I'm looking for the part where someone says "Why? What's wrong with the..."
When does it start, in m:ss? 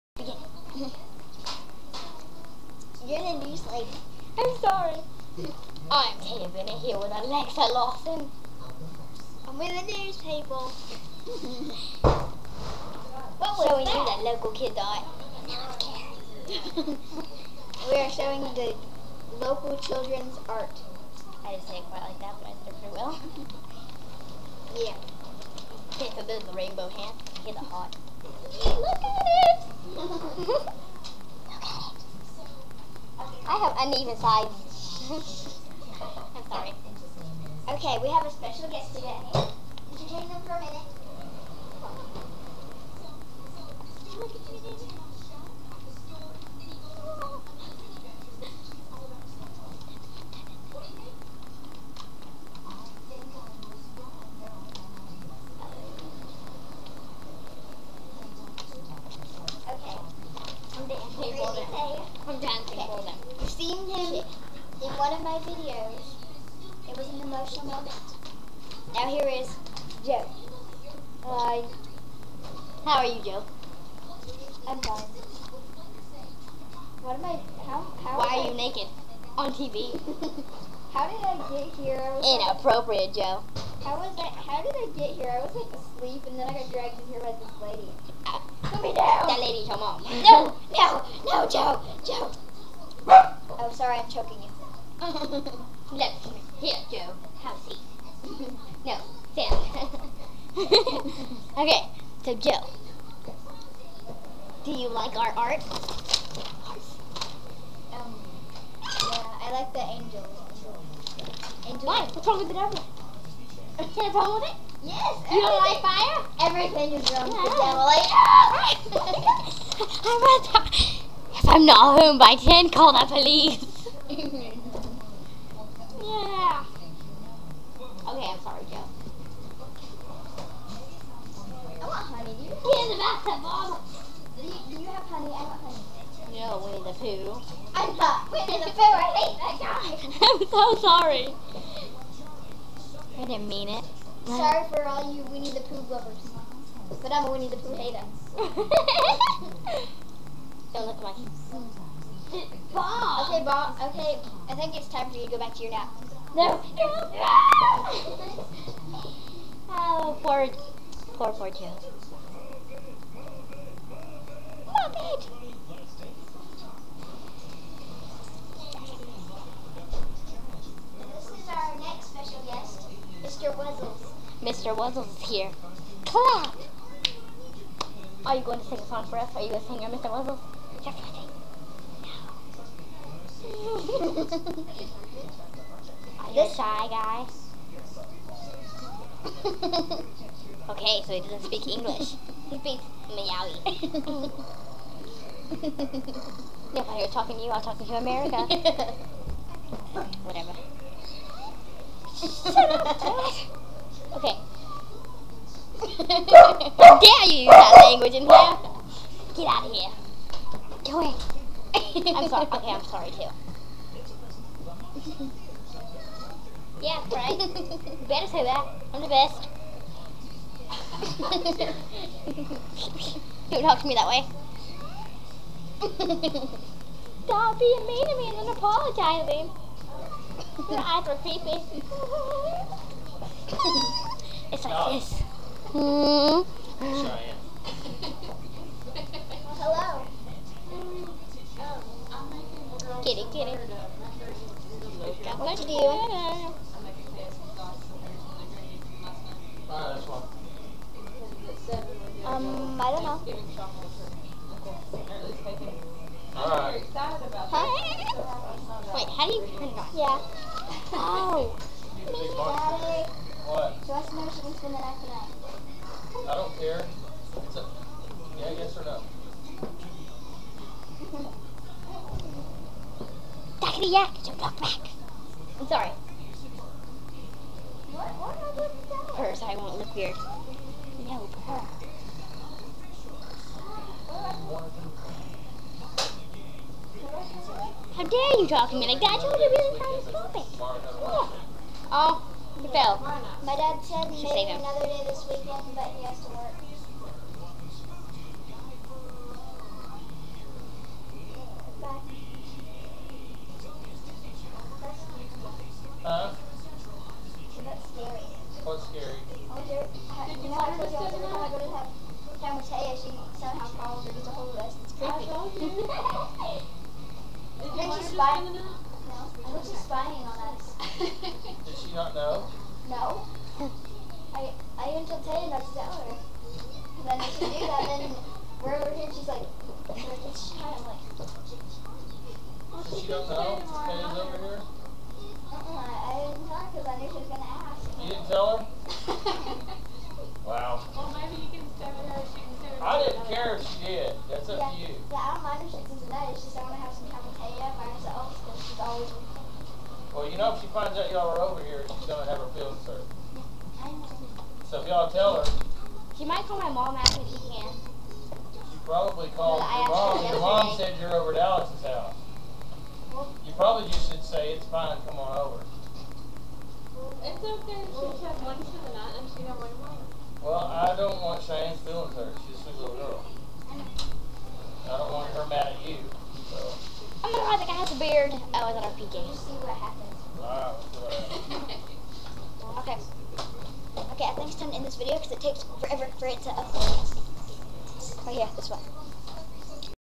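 1:51.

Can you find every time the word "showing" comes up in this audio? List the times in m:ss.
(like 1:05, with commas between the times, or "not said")
0:13, 0:18.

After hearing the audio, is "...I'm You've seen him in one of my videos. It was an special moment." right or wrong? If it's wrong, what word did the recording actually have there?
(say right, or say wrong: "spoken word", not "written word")
wrong: "emotional", not "special".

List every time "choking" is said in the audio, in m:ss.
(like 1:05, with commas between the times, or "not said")
1:34.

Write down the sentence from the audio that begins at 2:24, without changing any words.
Sorry for all you Winnie the Pooh lovers.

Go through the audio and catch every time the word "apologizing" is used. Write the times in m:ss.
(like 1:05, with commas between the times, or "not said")
3:48.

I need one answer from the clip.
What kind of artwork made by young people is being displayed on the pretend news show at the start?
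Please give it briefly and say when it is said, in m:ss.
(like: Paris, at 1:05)
local children's art, at 0:19.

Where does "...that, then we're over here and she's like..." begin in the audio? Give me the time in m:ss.
5:27.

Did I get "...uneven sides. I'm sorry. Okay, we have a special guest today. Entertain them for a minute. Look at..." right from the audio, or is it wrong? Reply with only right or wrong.
right.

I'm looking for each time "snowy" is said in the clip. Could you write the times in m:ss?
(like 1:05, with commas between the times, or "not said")
not said.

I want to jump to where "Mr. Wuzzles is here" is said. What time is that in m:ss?
2:54.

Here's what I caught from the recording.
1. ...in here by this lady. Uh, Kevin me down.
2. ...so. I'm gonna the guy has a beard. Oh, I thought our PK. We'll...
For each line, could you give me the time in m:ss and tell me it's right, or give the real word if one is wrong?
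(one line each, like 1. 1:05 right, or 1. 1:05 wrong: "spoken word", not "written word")
1. 1:27 wrong: "Put", not "Kevin"
2. 6:16 right.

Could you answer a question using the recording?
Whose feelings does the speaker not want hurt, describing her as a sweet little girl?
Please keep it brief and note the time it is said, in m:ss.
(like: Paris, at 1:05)
Cheyenne, at 6:11.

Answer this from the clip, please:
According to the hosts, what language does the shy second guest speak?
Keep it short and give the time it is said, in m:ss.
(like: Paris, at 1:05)
Malawi, at 3:13.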